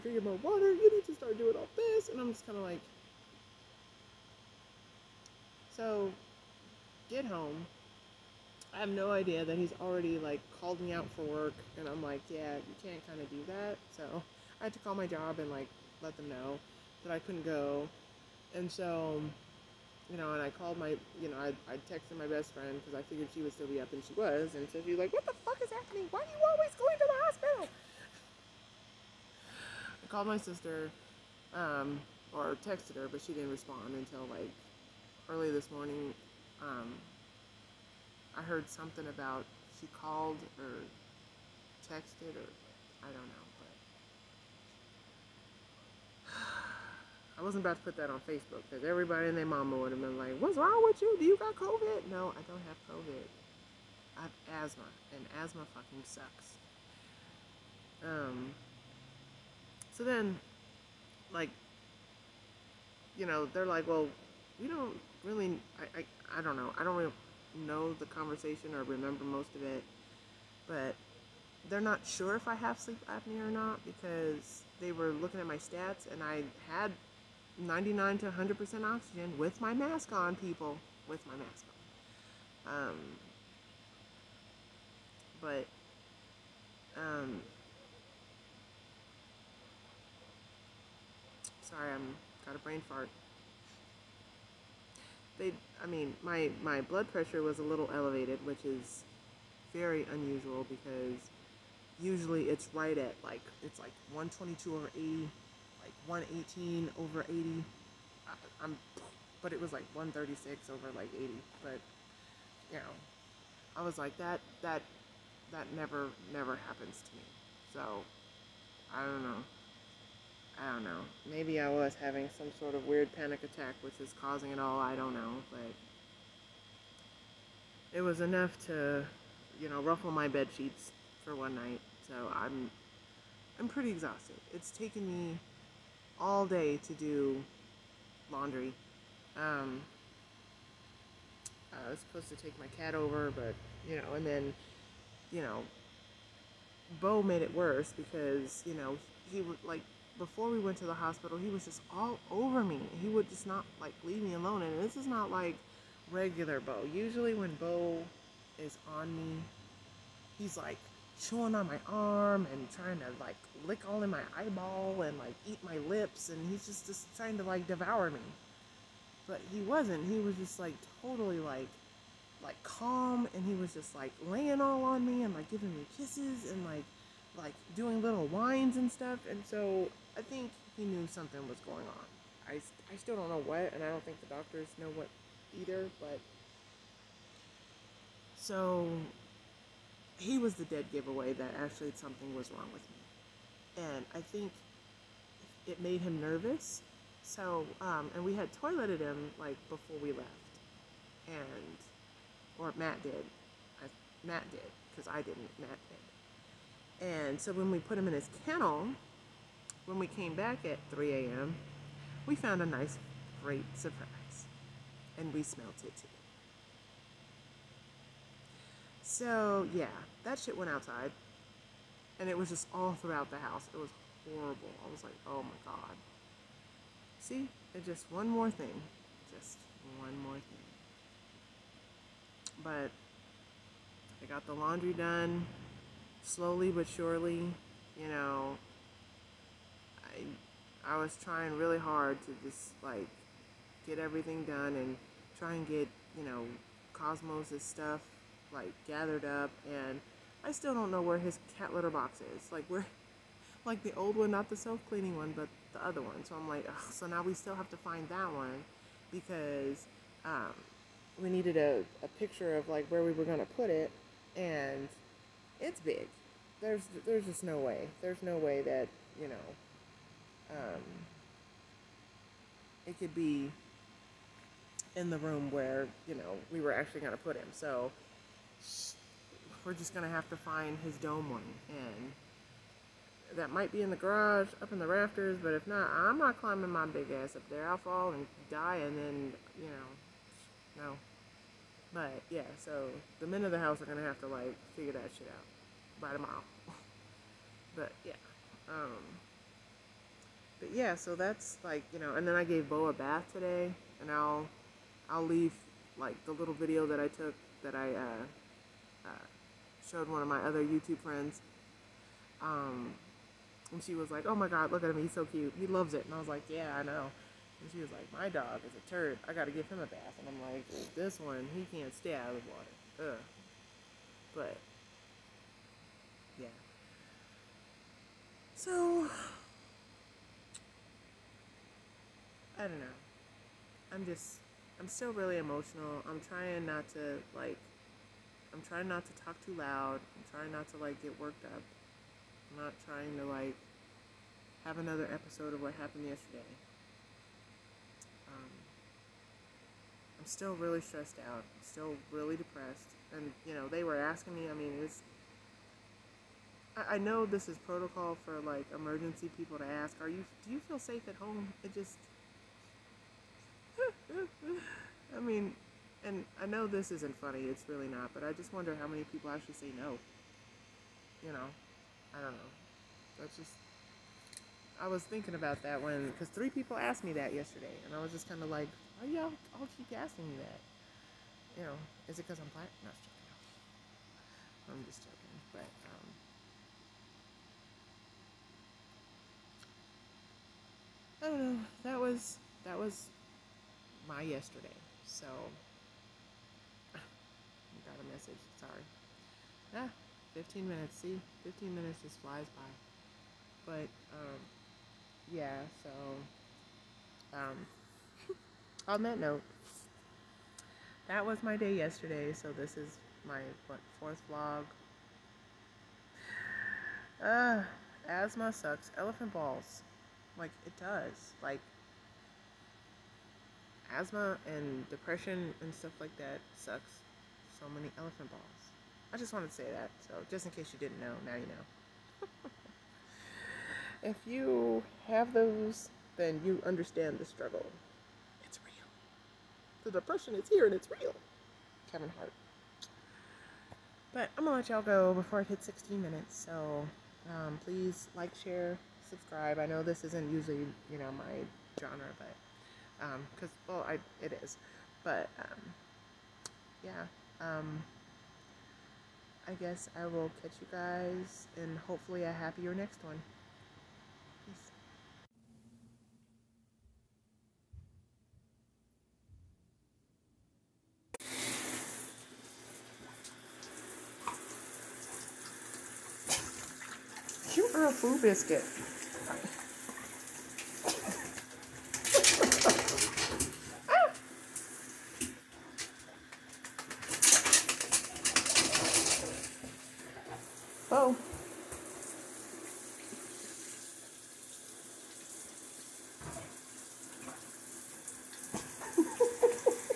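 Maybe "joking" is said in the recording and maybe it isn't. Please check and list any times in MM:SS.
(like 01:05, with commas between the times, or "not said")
06:24.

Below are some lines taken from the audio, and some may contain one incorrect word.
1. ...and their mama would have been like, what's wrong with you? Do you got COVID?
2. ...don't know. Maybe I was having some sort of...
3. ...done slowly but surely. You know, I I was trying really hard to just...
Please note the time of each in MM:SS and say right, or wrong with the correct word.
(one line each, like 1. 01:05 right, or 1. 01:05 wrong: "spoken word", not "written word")
1. 00:49 right
2. 02:00 right
3. 03:54 right.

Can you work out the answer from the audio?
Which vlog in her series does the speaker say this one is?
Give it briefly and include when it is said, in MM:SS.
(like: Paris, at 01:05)
4th, at 06:53.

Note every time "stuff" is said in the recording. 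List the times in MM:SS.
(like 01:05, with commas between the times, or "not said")
02:58, 04:07, 07:05.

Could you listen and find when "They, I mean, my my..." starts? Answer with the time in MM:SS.
01:35.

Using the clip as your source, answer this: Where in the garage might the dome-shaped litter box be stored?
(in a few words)
Up in the rafters.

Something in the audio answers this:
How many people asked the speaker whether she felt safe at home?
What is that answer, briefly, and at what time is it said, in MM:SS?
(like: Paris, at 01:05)
3, at 06:16.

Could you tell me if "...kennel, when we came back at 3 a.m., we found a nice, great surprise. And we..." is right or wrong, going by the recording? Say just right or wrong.
right.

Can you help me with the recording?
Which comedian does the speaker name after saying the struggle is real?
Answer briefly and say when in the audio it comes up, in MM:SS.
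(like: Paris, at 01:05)
Kevin Hart, at 07:21.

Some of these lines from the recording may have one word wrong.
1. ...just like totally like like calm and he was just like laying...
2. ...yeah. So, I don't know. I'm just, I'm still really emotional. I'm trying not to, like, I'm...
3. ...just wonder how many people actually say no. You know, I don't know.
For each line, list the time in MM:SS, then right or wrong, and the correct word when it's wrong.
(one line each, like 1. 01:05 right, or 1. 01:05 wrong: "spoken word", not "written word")
1. 02:50 right
2. 05:26 right
3. 06:08 right.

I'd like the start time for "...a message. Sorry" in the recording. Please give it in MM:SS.
06:38.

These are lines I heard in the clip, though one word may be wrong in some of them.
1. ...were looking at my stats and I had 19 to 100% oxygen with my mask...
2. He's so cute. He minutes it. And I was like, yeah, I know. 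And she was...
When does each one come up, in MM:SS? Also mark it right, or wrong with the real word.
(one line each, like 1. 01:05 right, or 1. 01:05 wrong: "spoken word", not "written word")
1. 01:14 wrong: "99", not "19"
2. 05:15 wrong: "loves", not "minutes".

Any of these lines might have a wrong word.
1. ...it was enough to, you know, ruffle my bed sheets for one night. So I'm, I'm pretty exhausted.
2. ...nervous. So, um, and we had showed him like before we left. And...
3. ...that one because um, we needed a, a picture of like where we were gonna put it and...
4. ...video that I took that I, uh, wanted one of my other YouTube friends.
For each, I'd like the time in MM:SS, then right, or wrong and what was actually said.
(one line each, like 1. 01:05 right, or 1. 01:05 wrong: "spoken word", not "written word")
1. 02:07 right
2. 03:16 wrong: "toileted", not "showed"
3. 04:18 right
4. 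05:06 wrong: "showed", not "wanted".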